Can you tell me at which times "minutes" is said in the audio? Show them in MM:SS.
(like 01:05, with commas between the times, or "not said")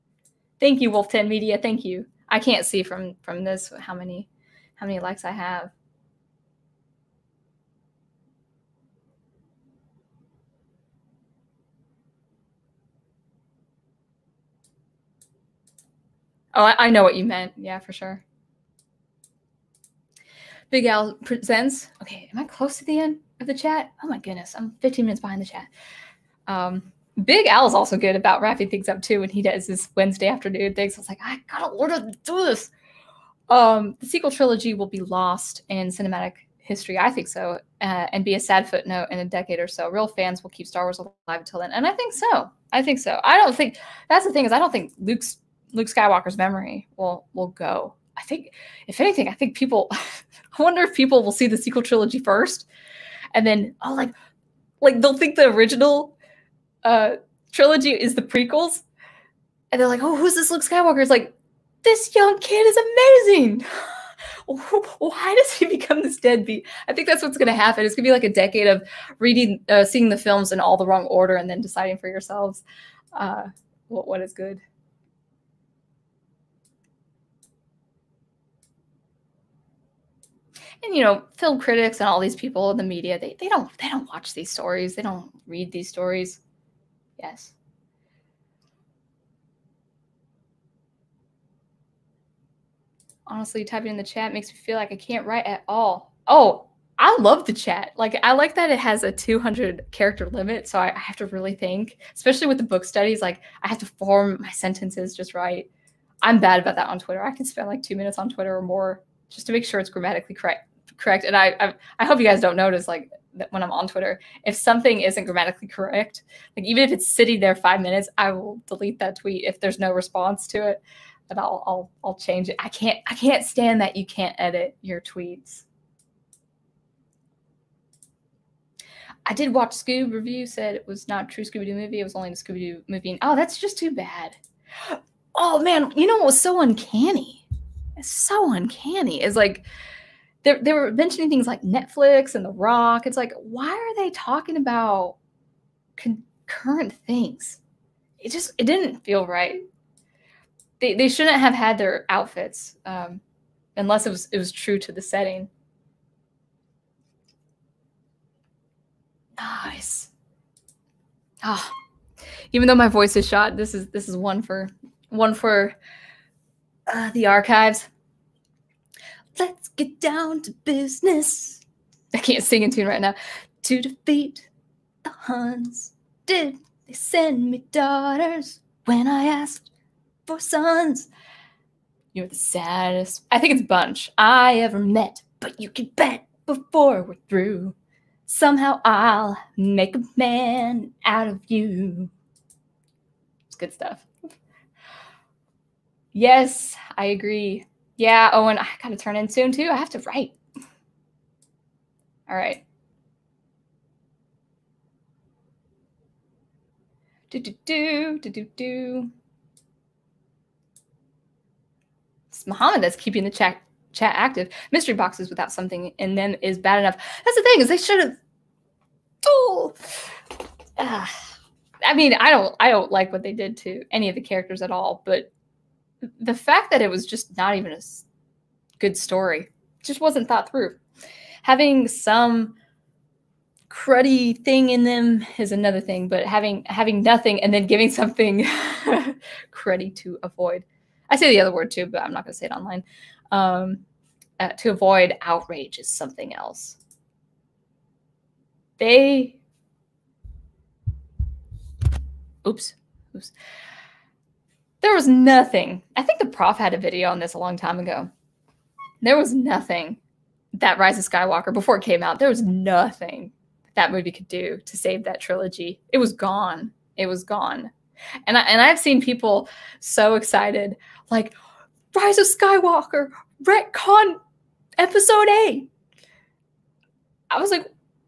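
00:25, 01:47, 01:57.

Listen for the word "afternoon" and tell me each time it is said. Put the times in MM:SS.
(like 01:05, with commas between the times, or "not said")
00:30.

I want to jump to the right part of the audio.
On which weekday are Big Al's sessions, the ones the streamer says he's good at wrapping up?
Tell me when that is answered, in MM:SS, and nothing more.
00:29.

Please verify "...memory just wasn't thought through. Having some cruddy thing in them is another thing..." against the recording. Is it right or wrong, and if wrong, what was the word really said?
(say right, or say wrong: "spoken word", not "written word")
wrong: "story", not "memory".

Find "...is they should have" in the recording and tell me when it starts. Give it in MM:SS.
03:37.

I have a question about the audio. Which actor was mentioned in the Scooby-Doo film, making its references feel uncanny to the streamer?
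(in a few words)
The Rock.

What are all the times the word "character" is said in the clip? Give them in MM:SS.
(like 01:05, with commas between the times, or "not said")
01:39, 03:44.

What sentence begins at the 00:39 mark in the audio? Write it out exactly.
Real fans will keep Star Wars alive until then, and I think so.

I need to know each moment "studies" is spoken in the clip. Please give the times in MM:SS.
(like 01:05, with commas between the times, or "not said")
01:42.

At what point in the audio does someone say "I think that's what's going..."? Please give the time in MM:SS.
01:06.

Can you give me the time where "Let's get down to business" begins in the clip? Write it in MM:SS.
02:49.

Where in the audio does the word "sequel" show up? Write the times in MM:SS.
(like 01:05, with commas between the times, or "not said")
00:34, 00:51.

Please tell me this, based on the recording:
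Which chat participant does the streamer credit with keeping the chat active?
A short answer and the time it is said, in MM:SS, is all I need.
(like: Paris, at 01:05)
Muhammad, at 03:32.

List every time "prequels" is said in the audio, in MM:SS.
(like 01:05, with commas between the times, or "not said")
00:58.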